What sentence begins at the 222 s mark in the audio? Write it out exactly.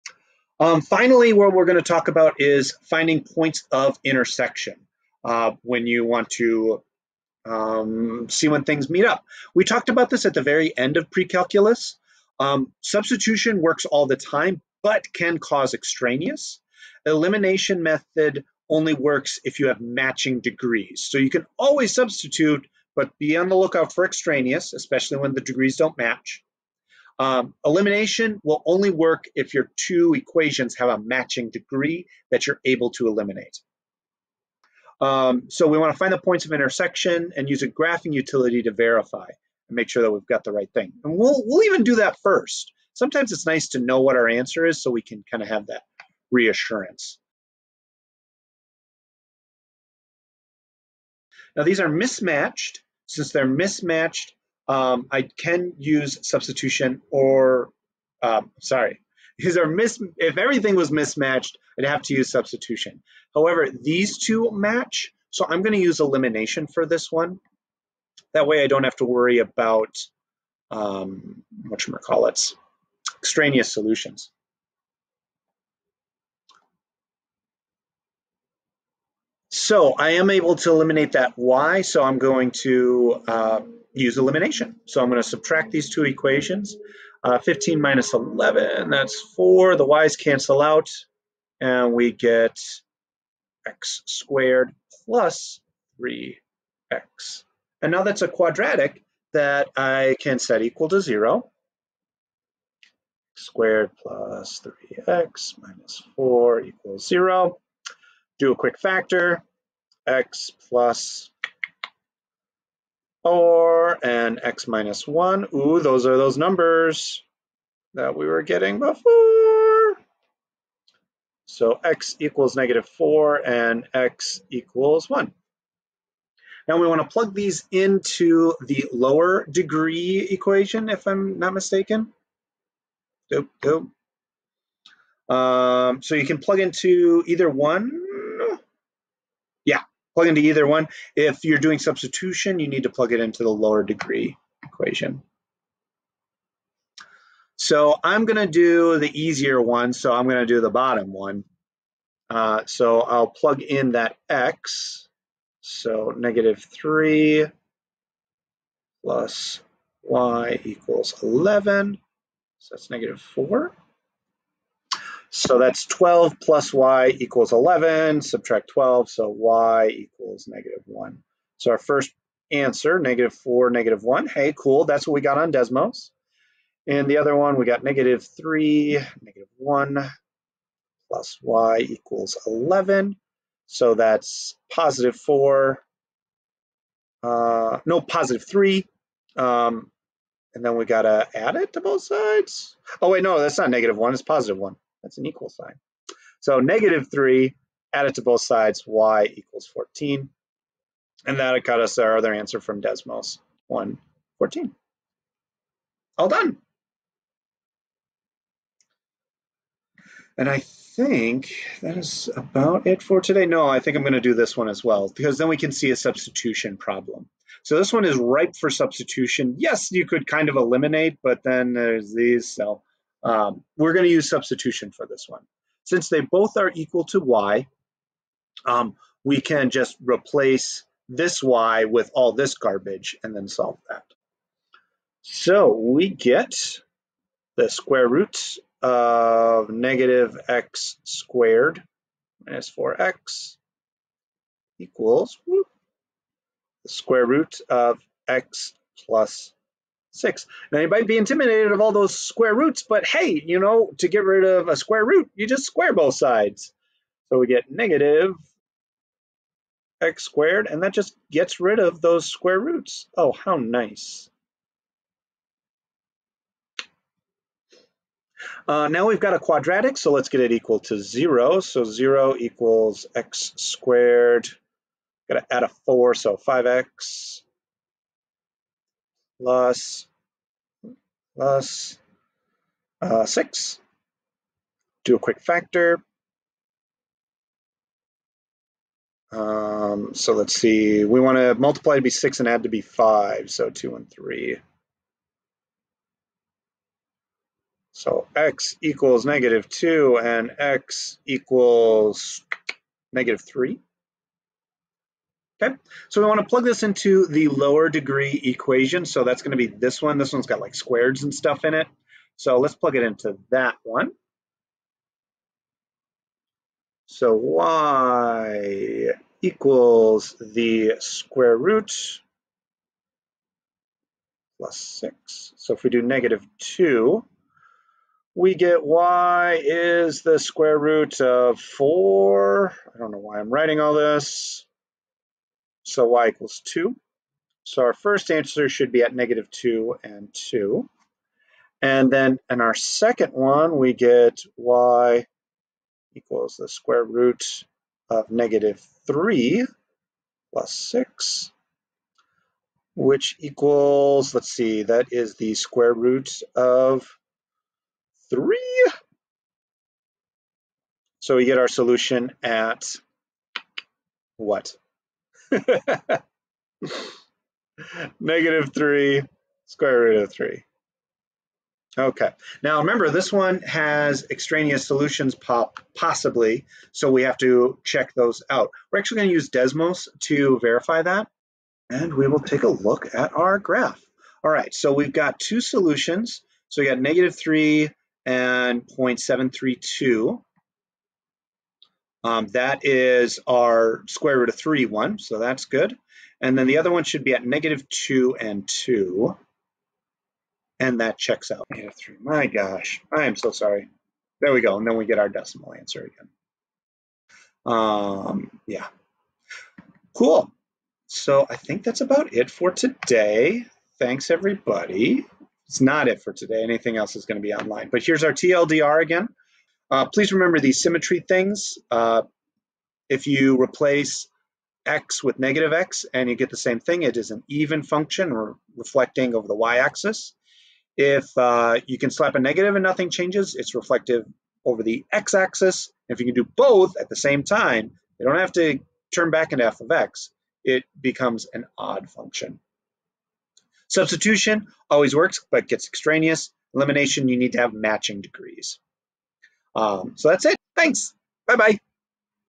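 So um, we're going to use substitution for this one.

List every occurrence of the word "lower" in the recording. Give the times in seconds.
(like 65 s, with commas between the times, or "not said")
128 s, 143 s, 307 s.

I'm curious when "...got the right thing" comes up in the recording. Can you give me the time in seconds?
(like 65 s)
40 s.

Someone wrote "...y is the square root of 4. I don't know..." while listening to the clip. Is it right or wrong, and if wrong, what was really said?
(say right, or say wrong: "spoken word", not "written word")
right.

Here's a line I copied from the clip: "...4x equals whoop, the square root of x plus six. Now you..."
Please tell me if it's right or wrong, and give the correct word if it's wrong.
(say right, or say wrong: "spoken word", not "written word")
right.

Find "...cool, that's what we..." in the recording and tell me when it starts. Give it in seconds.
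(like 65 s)
174 s.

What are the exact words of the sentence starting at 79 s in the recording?
So I am able to eliminate that y, so I'm going to uh, use elimination.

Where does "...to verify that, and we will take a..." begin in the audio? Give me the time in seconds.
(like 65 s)
380 s.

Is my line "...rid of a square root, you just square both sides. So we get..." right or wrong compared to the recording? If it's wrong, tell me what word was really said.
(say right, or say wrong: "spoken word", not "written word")
right.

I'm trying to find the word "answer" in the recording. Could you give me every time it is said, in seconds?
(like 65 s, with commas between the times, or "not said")
44 s, 172 s, 202 s, 338 s, 405 s.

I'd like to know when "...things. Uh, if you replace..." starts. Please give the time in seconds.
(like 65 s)
421 s.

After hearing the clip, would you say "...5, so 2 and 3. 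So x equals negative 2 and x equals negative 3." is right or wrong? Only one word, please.
right.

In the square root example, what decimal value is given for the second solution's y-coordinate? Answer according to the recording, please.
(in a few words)
0.732.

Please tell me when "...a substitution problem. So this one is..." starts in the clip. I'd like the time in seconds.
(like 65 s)
215 s.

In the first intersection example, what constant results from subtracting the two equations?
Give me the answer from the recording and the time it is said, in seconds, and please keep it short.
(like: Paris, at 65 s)
4, at 88 s.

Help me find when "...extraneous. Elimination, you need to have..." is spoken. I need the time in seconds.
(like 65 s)
445 s.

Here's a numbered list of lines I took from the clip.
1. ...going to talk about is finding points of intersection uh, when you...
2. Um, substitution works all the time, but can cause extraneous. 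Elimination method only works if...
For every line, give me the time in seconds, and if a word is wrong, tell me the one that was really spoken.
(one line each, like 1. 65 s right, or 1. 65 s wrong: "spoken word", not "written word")
1. 1 s right
2. 12 s right.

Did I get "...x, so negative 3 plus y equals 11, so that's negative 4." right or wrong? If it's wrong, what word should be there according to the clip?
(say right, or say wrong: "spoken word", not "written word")
right.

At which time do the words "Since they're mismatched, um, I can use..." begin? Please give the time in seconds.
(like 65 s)
53 s.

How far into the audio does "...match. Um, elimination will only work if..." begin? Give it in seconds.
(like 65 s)
25 s.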